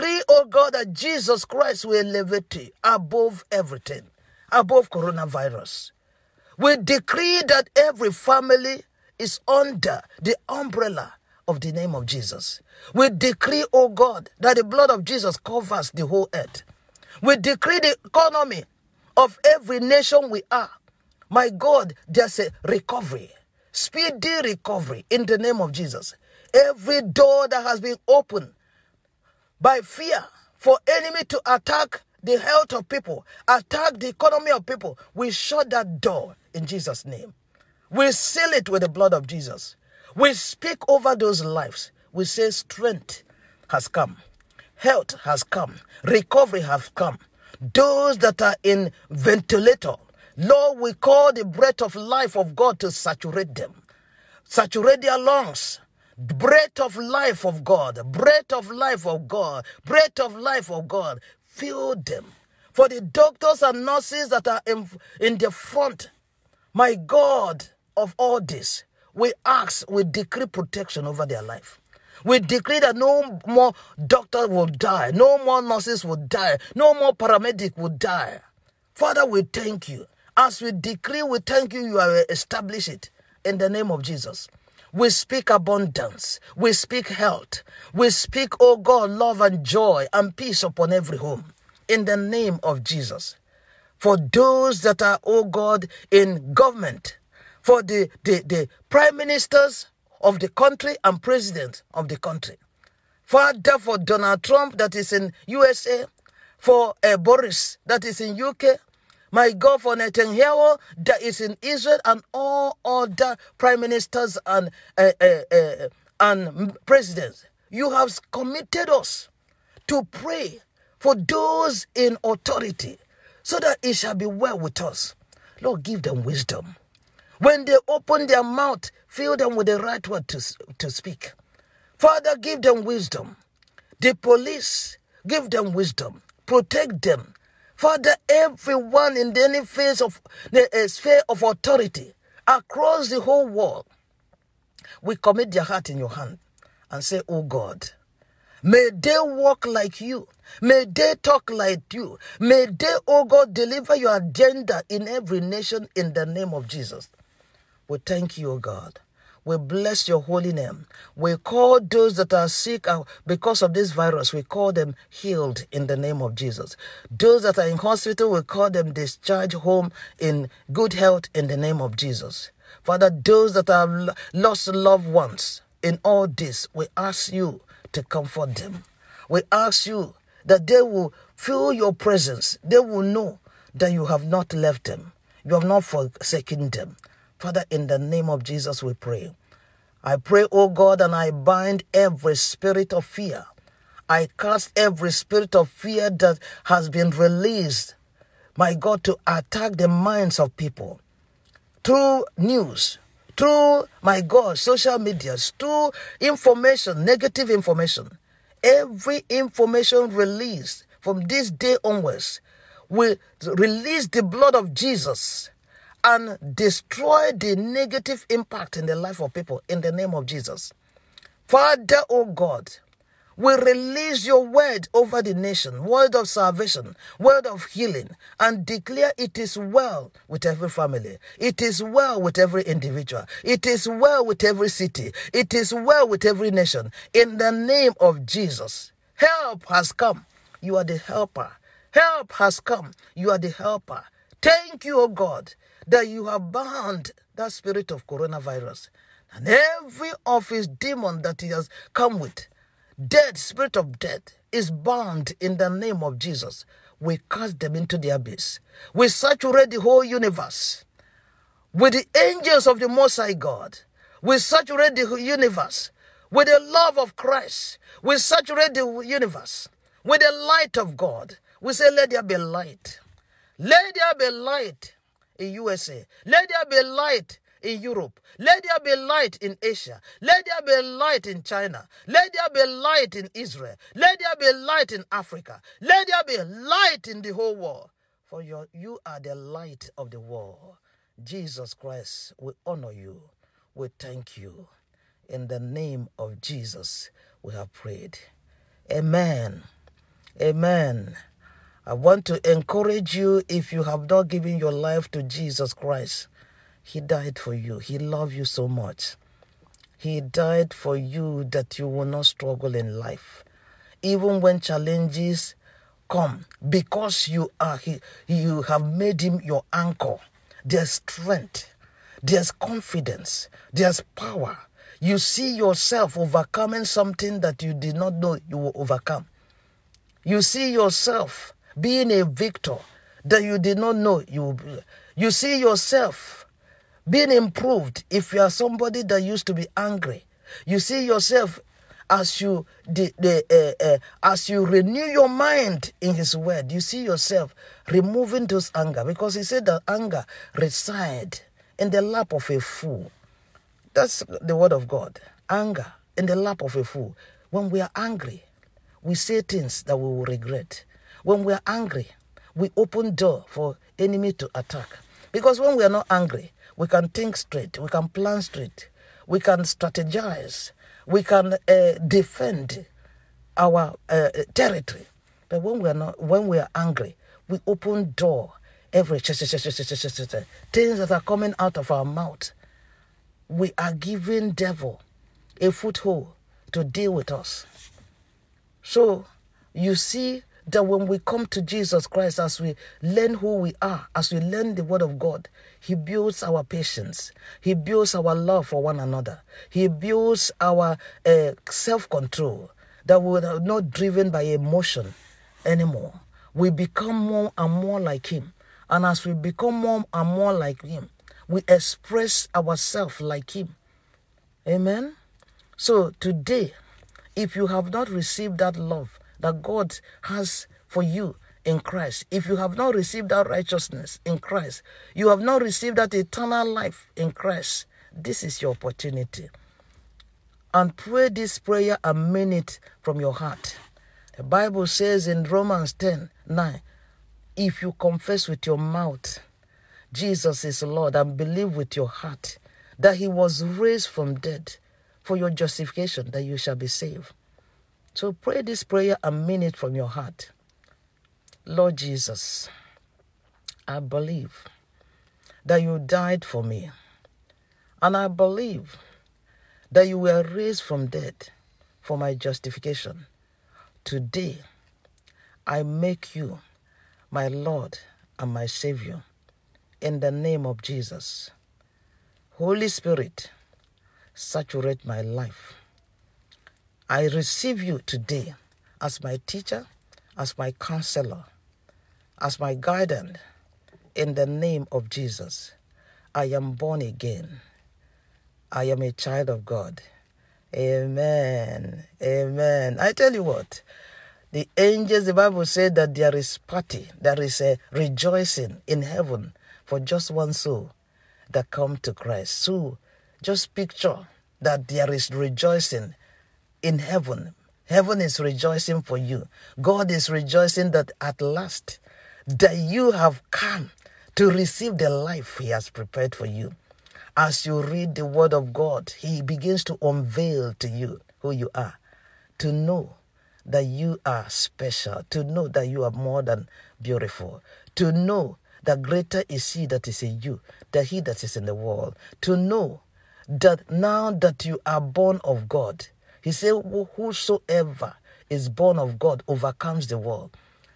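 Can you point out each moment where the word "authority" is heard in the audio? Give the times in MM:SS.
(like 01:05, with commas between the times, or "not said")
02:02, 02:21.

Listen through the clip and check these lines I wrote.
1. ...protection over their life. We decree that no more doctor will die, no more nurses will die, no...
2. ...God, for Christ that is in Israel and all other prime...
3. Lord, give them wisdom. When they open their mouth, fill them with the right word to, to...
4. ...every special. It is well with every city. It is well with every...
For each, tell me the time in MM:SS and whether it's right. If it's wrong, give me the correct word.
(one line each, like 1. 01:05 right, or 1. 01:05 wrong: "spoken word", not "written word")
1. 01:10 right
2. 01:49 wrong: "Netanyahu", not "Christ"
3. 02:05 right
4. 03:52 wrong: "individual", not "special".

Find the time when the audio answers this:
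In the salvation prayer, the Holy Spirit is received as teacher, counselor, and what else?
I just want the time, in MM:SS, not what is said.
08:02.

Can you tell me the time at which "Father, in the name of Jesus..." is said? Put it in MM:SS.
03:07.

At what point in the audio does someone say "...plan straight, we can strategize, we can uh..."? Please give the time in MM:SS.
06:08.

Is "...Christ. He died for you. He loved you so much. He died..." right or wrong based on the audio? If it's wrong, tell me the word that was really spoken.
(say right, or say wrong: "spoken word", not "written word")
right.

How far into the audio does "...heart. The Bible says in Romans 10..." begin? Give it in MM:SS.
07:13.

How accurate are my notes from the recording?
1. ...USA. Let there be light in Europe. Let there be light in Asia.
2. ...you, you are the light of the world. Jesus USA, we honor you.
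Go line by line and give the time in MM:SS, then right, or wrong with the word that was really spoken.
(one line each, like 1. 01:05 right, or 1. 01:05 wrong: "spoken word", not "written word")
1. 04:35 right
2. 04:48 wrong: "Christ", not "USA".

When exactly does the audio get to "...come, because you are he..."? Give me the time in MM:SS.
05:16.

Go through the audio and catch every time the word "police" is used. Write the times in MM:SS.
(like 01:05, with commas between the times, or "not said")
02:14.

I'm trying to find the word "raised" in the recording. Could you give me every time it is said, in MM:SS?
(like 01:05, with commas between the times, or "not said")
07:23, 07:40.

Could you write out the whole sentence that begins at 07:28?
So pray this prayer a minute from your heart.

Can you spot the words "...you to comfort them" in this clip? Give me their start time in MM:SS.
02:57.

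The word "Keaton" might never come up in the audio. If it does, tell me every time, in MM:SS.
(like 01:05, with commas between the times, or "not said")
not said.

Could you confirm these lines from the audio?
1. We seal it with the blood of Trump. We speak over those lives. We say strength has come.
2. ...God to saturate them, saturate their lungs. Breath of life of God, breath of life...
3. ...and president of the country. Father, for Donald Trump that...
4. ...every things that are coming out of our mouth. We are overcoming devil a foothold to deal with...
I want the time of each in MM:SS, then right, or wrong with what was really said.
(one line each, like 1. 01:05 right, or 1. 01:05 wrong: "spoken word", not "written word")
1. 00:37 wrong: "Jesus", not "Trump"
2. 00:52 right
3. 01:41 right
4. 06:18 wrong: "giving", not "overcoming".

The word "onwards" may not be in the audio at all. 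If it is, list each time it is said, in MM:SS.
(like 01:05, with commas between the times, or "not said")
03:31.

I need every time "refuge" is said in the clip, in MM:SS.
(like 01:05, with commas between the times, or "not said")
not said.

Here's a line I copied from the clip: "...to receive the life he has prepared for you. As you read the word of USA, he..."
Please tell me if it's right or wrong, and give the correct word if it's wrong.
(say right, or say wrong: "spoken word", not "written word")
wrong: "God", not "USA".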